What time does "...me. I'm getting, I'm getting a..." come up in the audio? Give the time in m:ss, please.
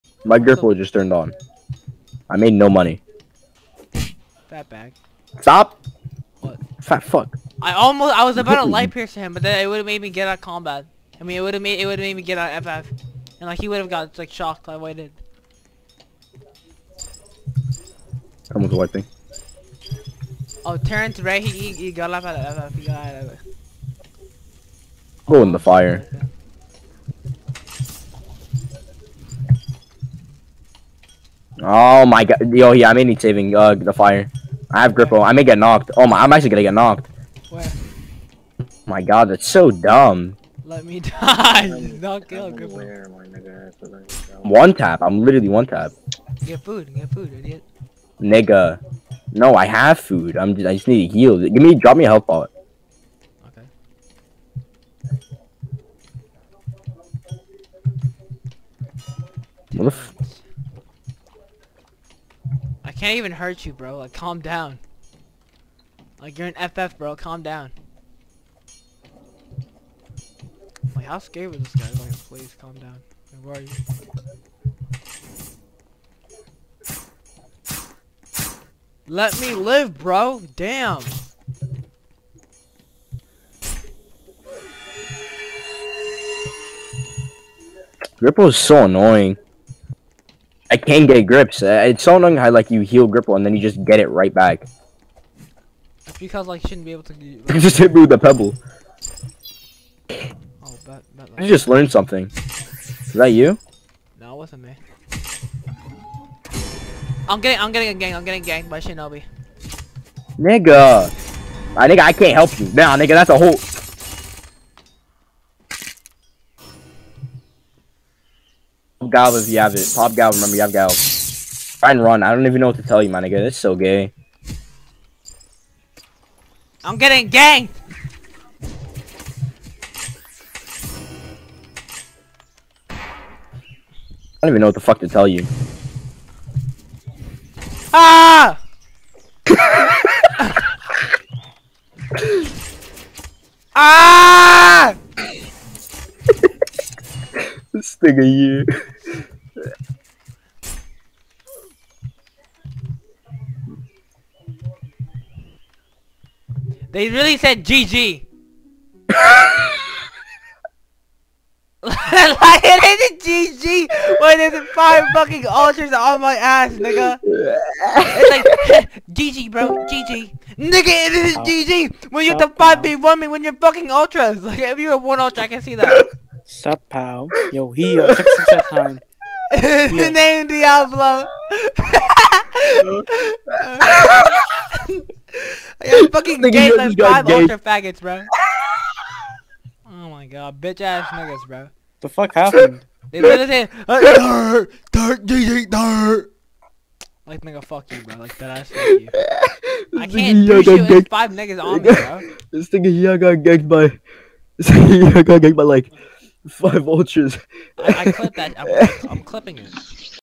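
1:44.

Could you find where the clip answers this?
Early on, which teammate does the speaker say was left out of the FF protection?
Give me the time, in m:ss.
0:20.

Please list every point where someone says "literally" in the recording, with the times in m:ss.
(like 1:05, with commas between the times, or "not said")
0:45, 3:13.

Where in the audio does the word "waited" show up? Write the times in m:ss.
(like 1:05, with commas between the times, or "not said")
0:14.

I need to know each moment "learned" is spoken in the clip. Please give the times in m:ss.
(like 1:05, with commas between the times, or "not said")
1:41.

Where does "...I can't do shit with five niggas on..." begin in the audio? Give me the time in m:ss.
3:19.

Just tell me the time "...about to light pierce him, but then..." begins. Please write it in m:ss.
0:08.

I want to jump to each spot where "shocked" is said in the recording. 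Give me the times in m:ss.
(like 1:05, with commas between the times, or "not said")
0:14.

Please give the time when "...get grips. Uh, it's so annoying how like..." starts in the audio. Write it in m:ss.
1:31.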